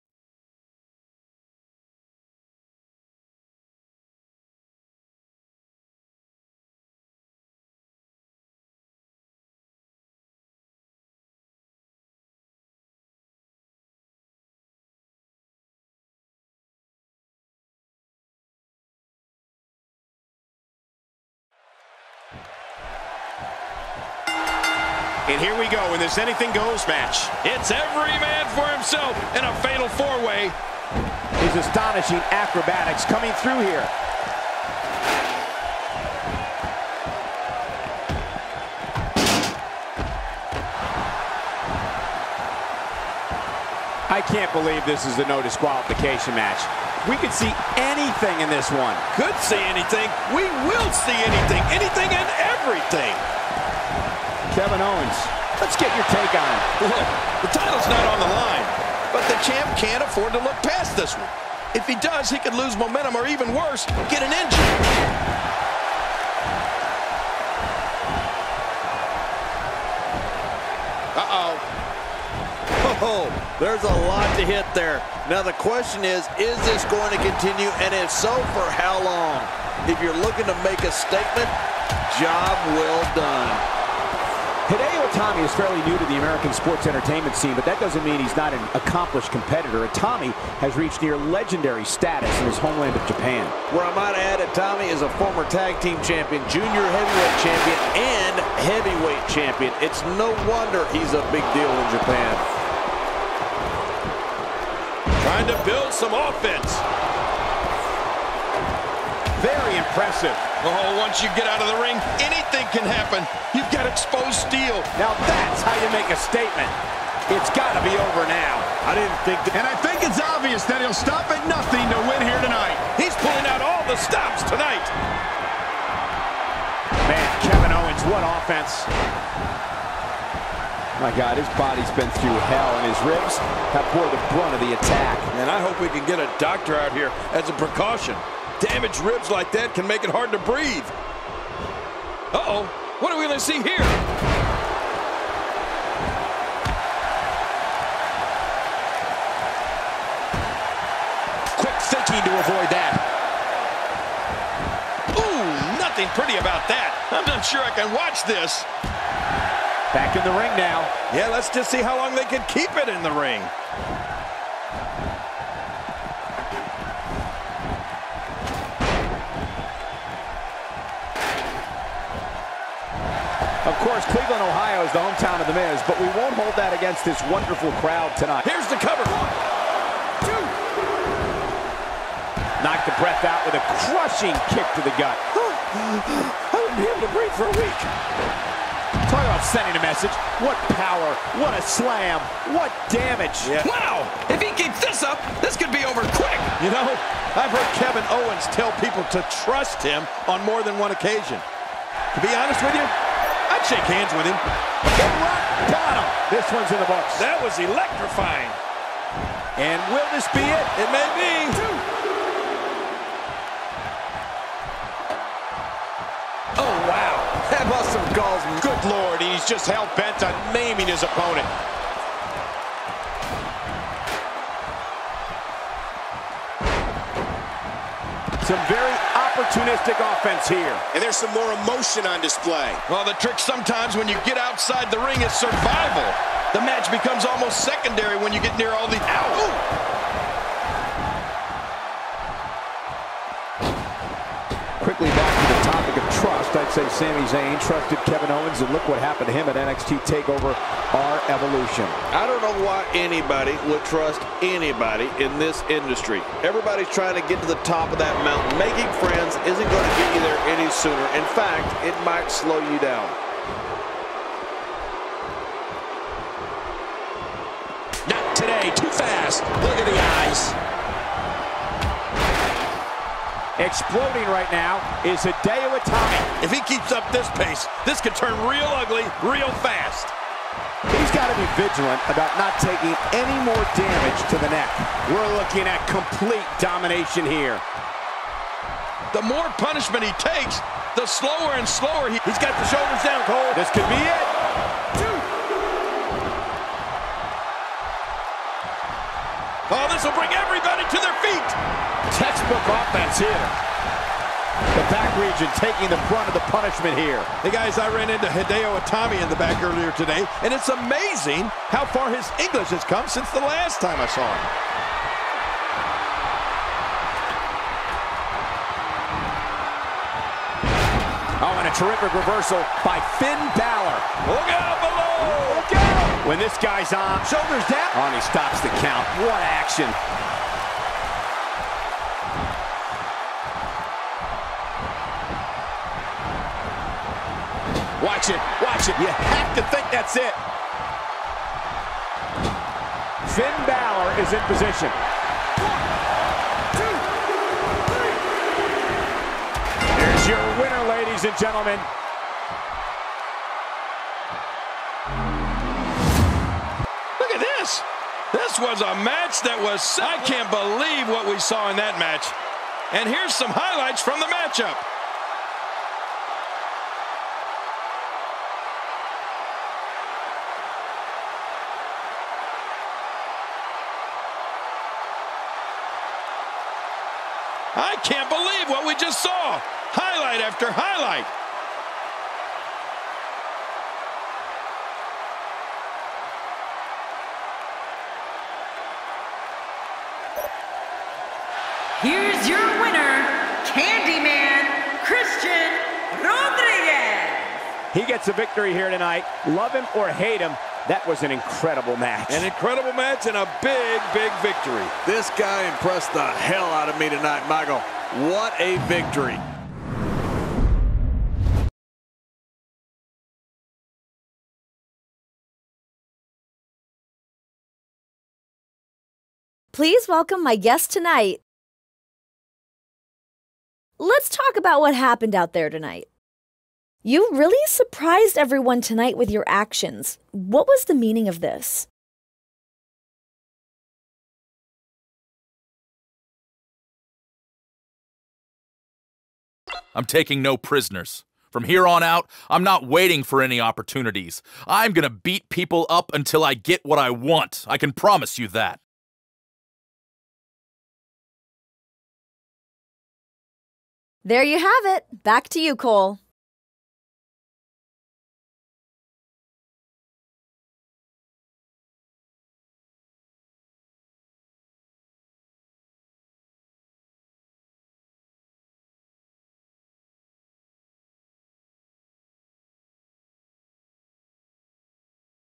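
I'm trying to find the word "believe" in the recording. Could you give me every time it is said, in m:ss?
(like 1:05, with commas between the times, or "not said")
0:44, 6:00, 6:18.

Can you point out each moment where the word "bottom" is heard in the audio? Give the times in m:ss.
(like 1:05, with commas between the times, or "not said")
3:25.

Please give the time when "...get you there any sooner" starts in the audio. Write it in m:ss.
4:19.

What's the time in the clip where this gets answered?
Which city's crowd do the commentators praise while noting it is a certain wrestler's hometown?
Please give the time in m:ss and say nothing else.
2:54.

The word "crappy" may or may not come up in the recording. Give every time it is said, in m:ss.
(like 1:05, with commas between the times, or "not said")
not said.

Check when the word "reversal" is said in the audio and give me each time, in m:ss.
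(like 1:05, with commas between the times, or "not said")
5:22.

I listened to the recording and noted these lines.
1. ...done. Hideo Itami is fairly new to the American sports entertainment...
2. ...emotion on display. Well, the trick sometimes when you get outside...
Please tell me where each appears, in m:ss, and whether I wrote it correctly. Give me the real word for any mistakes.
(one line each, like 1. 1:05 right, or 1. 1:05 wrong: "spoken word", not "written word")
1. 1:23 right
2. 3:51 right.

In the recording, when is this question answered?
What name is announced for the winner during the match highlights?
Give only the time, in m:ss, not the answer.
6:33.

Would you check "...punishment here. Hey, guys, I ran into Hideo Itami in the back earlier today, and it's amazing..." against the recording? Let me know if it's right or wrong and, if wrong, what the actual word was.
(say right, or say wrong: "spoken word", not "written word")
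right.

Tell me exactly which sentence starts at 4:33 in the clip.
Exploding right now is Hideo Itami.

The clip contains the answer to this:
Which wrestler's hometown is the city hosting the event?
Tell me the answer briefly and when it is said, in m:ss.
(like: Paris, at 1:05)
The Miz, at 2:55.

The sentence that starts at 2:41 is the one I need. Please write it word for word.
Yeah, let's just see how long they can keep it in the ring.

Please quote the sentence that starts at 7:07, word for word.
You really surprised everyone tonight with your actions.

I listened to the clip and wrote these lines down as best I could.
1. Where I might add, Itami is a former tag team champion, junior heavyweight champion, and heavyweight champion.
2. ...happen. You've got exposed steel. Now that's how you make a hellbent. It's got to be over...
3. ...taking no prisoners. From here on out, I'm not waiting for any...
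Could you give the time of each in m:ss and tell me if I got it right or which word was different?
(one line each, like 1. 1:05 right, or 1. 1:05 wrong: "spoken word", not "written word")
1. 1:33 right
2. 1:52 wrong: "statement", not "hellbent"
3. 7:20 right.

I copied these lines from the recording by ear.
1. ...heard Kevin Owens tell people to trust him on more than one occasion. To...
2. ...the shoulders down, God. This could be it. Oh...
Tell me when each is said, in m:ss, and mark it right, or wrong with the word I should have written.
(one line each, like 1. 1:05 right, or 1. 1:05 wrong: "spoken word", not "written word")
1. 3:17 right
2. 4:52 wrong: "Cole", not "God".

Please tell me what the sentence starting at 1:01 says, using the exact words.
If he does, he could lose momentum or even worse, get an injury.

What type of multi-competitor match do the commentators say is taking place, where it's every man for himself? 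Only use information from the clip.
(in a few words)
Fatal four-way.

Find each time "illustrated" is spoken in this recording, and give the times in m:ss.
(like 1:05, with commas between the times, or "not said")
not said.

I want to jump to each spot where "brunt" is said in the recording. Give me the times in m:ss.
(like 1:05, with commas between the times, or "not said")
2:14, 5:06.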